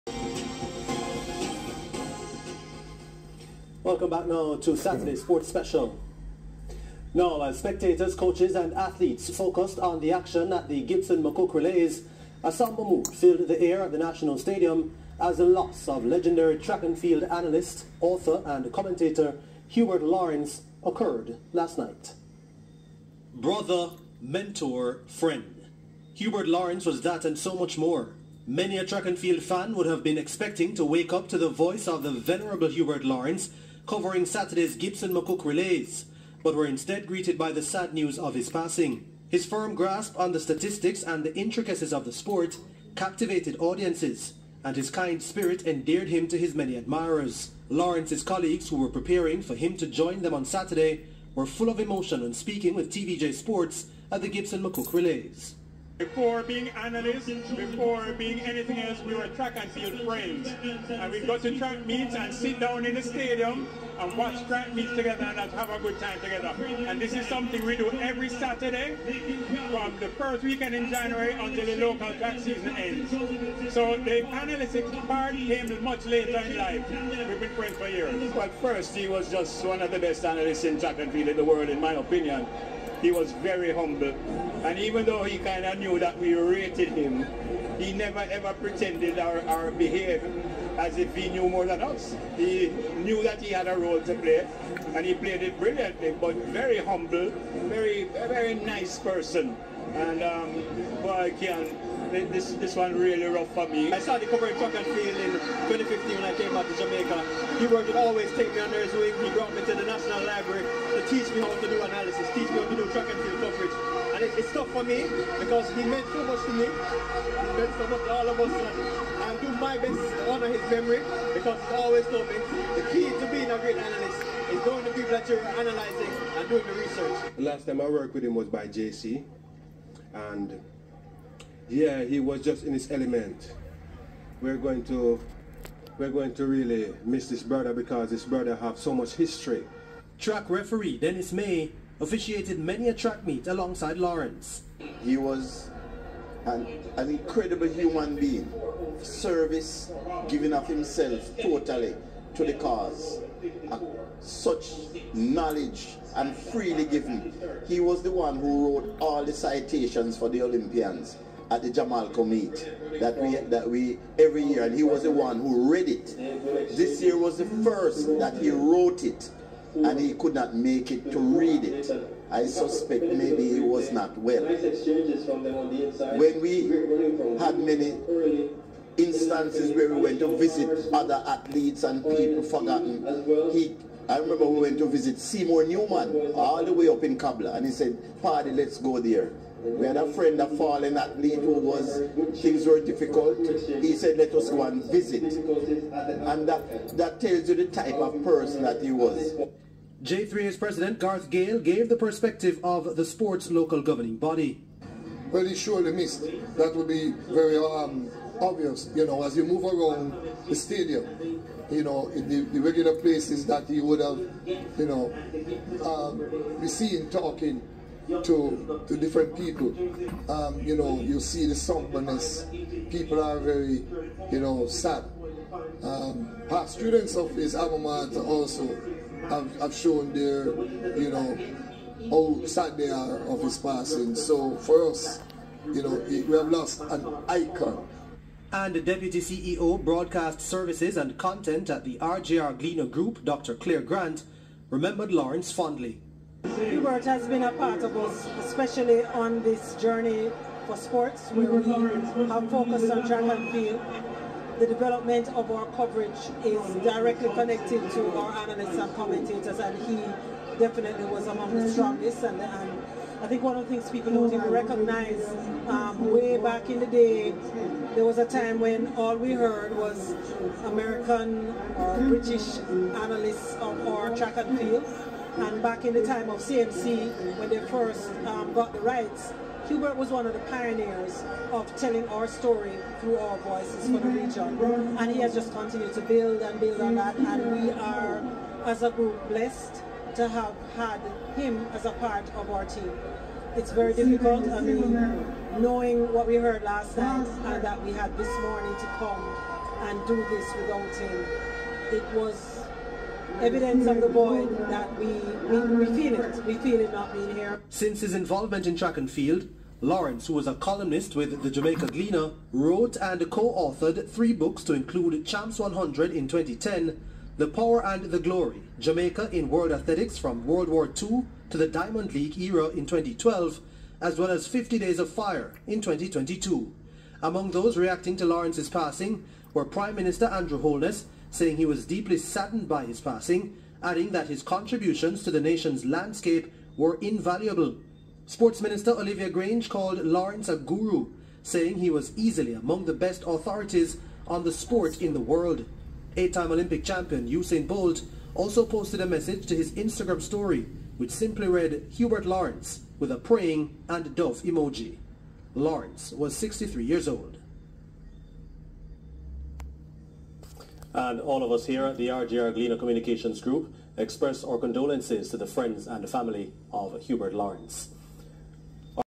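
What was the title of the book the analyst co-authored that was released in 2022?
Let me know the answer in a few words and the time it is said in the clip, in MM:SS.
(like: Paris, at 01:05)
50 Days of Fire, at 05:24.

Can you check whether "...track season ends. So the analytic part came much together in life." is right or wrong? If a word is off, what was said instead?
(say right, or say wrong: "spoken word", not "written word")
wrong: "later", not "together".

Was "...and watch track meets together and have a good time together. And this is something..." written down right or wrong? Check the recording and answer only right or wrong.
right.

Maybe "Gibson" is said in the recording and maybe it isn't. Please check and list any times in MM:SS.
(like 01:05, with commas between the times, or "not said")
00:10, 00:34, 00:54.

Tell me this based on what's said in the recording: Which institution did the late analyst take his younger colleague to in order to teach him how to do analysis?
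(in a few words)
National Library.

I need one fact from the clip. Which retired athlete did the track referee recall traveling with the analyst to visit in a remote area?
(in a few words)
Seymour Newman.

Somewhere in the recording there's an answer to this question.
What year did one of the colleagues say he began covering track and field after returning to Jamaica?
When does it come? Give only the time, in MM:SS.
01:45.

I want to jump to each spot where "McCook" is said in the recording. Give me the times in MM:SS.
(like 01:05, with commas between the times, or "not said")
00:11, 00:35, 00:54.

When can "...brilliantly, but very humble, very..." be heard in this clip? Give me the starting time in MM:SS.
01:35.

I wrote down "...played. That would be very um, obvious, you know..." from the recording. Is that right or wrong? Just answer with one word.
wrong.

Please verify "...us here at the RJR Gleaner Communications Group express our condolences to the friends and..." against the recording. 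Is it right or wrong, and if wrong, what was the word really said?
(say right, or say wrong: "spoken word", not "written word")
right.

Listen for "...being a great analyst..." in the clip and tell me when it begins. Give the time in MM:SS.
02:03.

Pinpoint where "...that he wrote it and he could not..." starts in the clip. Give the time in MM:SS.
02:48.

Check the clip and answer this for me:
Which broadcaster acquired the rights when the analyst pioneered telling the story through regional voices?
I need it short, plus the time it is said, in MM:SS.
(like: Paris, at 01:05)
CMC, at 04:36.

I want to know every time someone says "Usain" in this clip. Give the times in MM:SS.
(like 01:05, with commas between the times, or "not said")
05:47.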